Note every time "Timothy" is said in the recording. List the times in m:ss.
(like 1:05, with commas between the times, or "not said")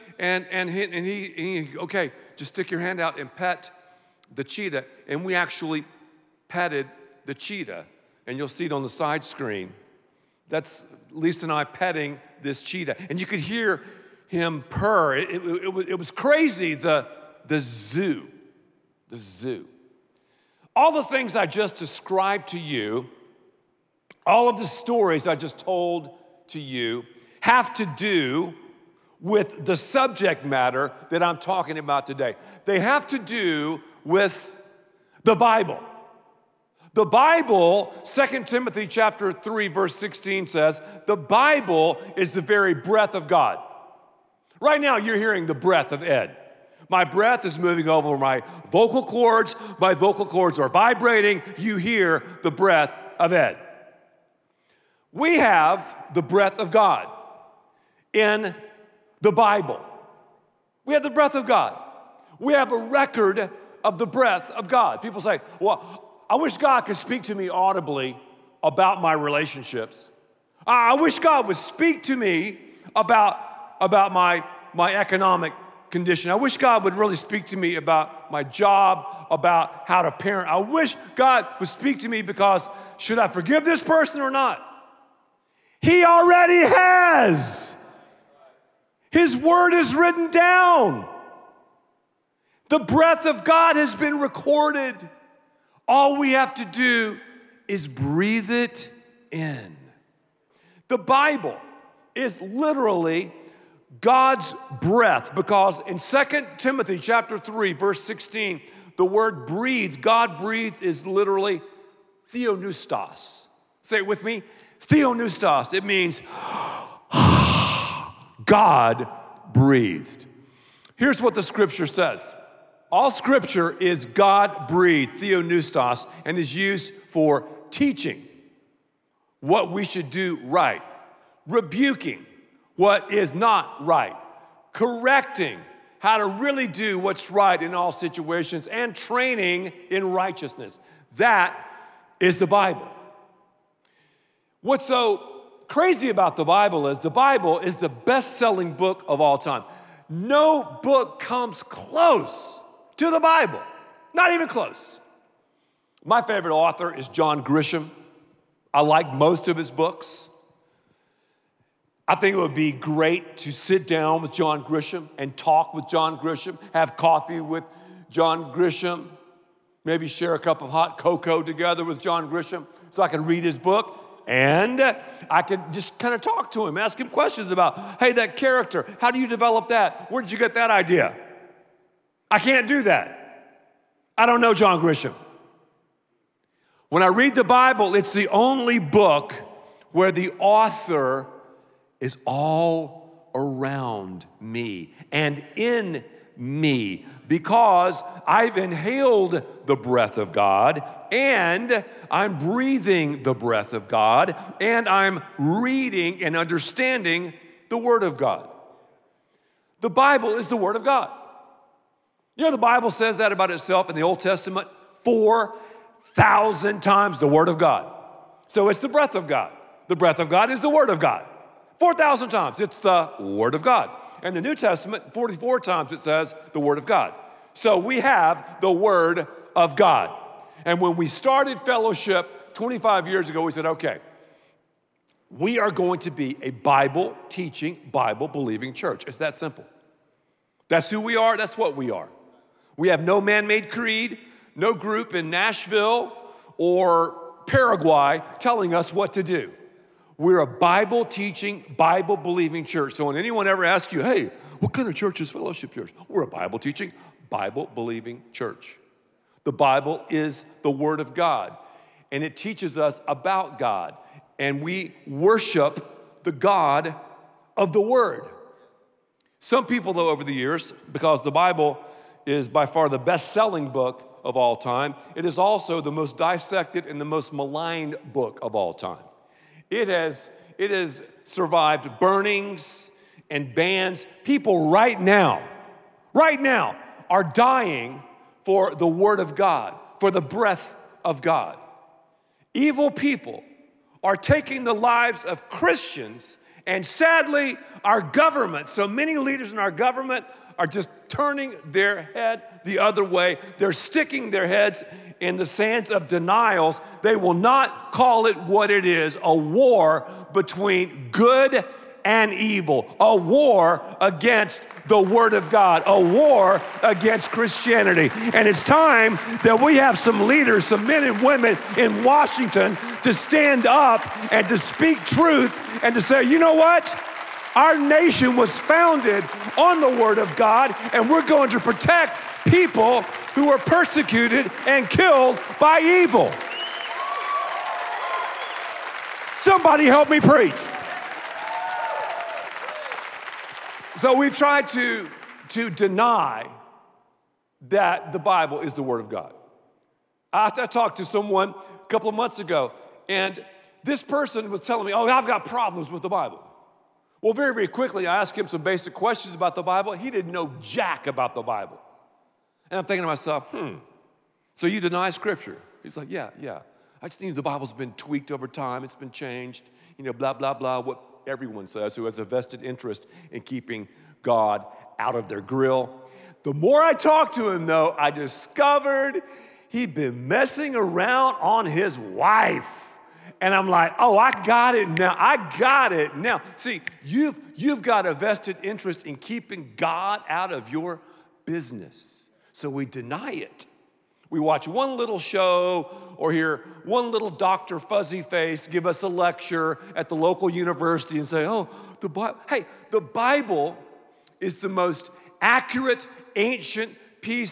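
0:38, 1:46.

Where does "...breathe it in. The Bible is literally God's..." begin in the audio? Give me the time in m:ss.
1:37.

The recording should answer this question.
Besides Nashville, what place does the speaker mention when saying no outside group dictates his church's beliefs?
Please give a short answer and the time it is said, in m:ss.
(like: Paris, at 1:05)
Paraguay, at 4:07.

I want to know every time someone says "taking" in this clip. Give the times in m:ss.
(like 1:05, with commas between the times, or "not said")
4:54.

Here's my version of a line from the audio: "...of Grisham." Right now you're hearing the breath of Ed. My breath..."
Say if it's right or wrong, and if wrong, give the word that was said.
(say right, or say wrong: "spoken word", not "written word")
wrong: "God", not "Grisham".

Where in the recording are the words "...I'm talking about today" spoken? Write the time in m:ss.
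0:31.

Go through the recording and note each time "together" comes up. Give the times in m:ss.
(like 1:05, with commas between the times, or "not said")
2:51.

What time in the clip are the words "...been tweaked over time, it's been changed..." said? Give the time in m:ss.
6:07.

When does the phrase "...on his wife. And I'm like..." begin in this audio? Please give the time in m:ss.
6:21.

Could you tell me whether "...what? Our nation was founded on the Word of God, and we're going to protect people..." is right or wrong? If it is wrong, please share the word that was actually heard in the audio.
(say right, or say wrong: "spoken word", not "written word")
right.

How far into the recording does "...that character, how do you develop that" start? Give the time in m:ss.
2:58.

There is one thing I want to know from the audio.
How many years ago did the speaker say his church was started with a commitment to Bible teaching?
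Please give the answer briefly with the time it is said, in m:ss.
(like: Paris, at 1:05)
25, at 3:52.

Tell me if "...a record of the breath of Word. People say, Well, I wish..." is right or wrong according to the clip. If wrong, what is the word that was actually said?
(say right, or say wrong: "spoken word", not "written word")
wrong: "God", not "Word".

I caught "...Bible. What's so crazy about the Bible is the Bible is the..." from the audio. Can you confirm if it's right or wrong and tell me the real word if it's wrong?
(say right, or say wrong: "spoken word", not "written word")
right.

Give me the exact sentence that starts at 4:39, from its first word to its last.
It has, it has survived burnings and bans.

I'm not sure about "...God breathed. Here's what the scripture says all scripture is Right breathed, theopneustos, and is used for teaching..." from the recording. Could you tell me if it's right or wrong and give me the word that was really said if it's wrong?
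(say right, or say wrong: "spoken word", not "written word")
wrong: "God", not "Right".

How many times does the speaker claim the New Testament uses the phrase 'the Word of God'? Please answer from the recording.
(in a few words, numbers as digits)
44.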